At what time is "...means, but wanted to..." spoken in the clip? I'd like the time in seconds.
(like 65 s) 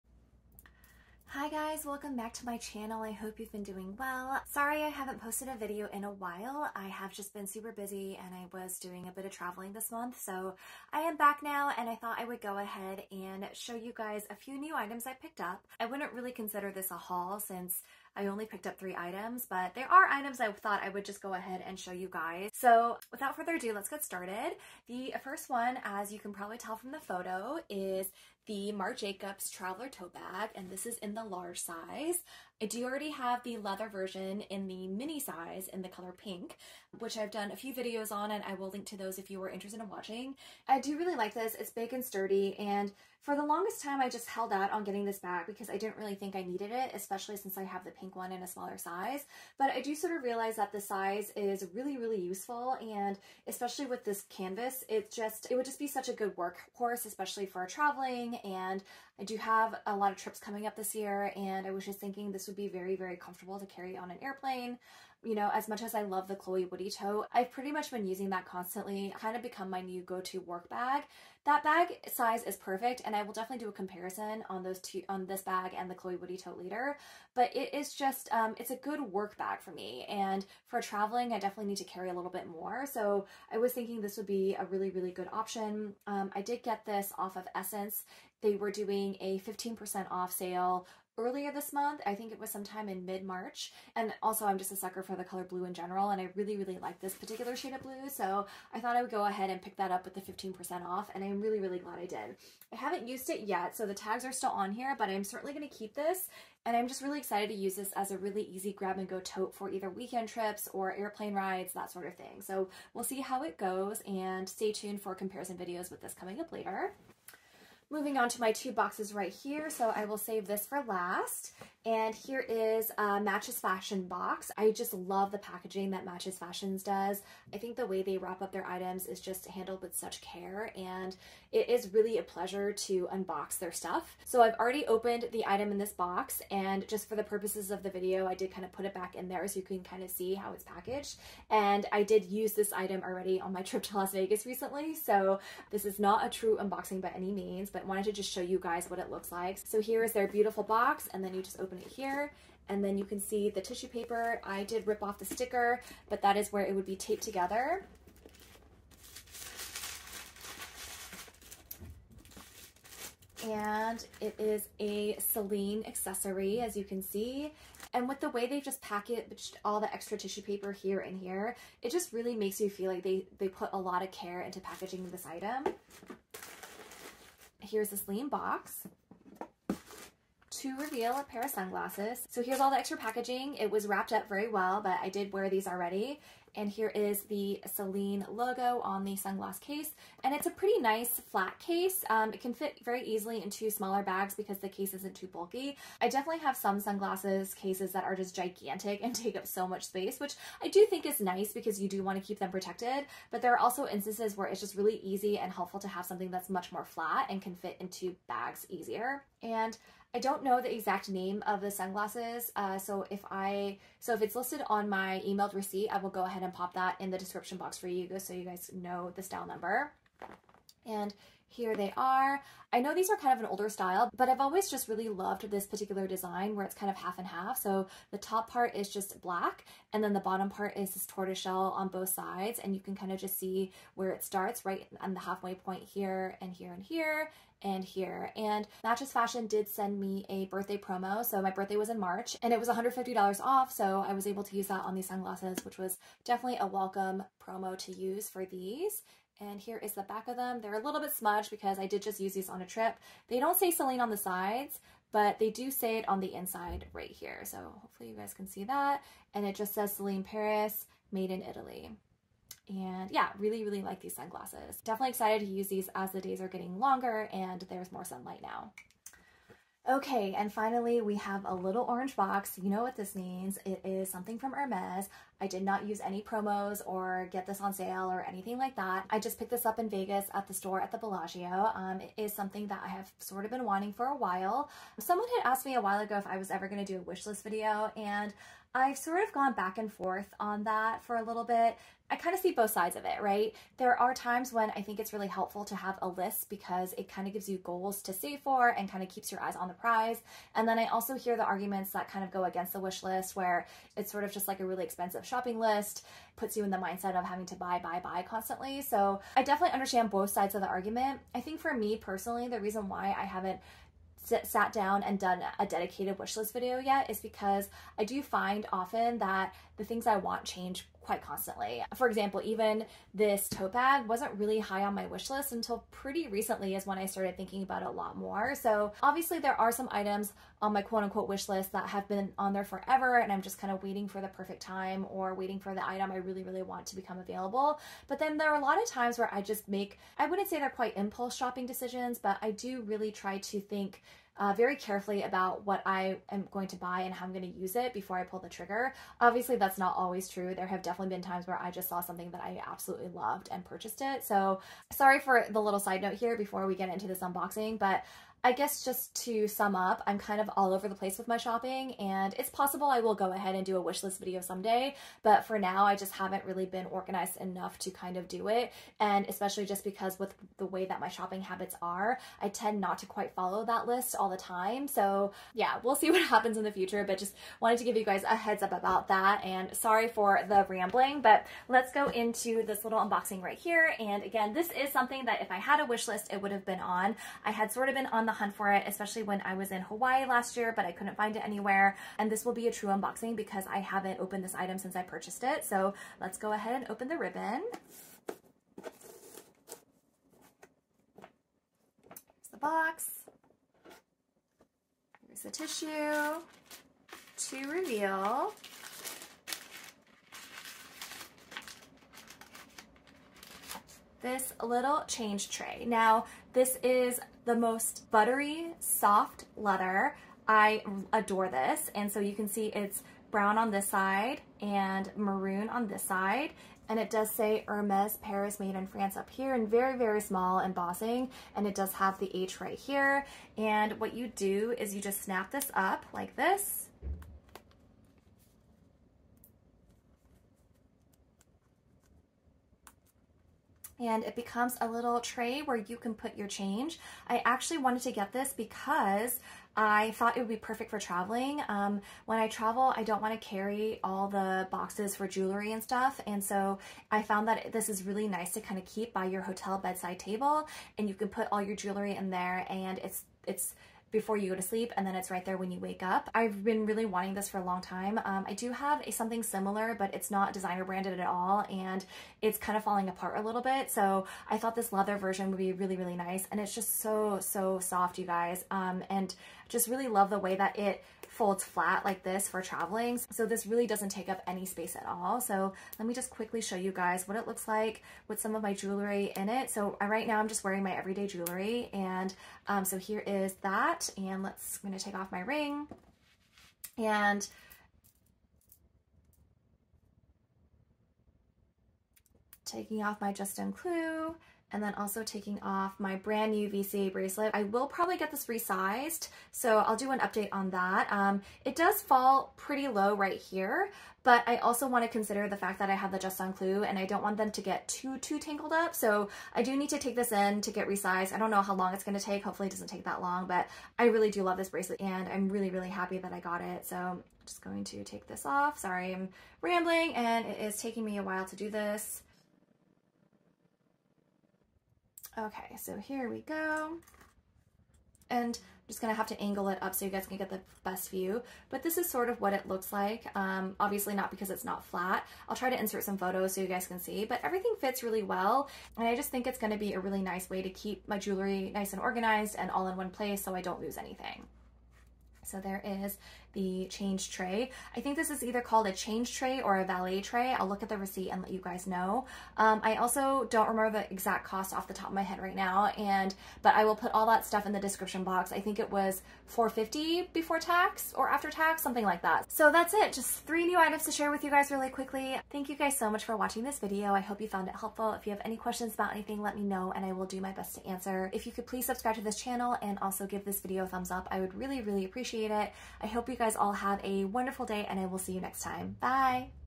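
147 s.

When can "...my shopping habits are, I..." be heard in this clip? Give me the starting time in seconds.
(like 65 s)
370 s.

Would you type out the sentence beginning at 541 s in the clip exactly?
But this is sort of what it looks like.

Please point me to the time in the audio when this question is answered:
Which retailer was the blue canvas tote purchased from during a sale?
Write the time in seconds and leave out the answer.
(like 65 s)
87 s.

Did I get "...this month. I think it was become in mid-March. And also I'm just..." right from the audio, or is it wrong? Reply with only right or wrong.
wrong.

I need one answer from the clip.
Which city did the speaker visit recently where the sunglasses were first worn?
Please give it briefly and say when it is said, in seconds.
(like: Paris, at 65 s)
Las Vegas, at 143 s.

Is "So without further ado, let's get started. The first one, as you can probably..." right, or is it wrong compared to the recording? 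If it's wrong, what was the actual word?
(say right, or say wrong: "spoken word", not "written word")
right.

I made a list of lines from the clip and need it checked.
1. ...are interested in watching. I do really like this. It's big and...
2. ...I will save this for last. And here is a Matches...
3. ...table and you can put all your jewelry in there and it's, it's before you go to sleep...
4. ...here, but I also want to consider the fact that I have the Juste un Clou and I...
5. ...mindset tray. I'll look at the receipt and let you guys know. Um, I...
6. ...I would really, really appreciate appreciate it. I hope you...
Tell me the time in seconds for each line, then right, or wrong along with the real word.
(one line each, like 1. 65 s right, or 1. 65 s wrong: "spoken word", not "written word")
1. 39 s right
2. 119 s right
3. 460 s right
4. 513 s right
5. 559 s wrong: "valet", not "mindset"
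6. 584 s right.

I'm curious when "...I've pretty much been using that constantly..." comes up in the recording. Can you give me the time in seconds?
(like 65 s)
67 s.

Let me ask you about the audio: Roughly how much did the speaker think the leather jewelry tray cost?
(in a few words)
450.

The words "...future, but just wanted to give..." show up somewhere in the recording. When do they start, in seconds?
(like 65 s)
376 s.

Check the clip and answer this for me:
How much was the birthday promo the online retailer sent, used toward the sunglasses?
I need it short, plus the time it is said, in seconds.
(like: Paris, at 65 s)
$150 off, at 242 s.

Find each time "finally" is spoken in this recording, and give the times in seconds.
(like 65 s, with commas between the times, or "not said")
270 s.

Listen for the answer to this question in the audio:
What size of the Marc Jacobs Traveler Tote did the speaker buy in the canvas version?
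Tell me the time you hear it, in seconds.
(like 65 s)
31 s.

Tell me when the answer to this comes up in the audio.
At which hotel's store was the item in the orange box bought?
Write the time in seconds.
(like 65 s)
280 s.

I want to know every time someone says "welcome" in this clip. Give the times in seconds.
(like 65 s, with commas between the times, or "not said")
1 s, 246 s.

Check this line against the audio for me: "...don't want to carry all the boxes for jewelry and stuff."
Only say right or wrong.
right.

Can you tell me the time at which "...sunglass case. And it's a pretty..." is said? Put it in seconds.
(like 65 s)
189 s.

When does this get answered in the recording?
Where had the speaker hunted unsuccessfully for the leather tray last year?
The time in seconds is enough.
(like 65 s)
389 s.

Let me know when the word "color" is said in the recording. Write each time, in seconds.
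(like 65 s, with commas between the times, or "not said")
35 s, 95 s.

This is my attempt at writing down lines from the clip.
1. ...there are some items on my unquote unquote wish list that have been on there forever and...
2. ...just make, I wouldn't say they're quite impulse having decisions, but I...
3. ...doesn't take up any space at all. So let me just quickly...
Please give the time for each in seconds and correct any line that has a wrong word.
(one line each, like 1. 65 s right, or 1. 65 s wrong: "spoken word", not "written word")
1. 329 s wrong: "quote", not "unquote"
2. 339 s wrong: "shopping", not "having"
3. 483 s right.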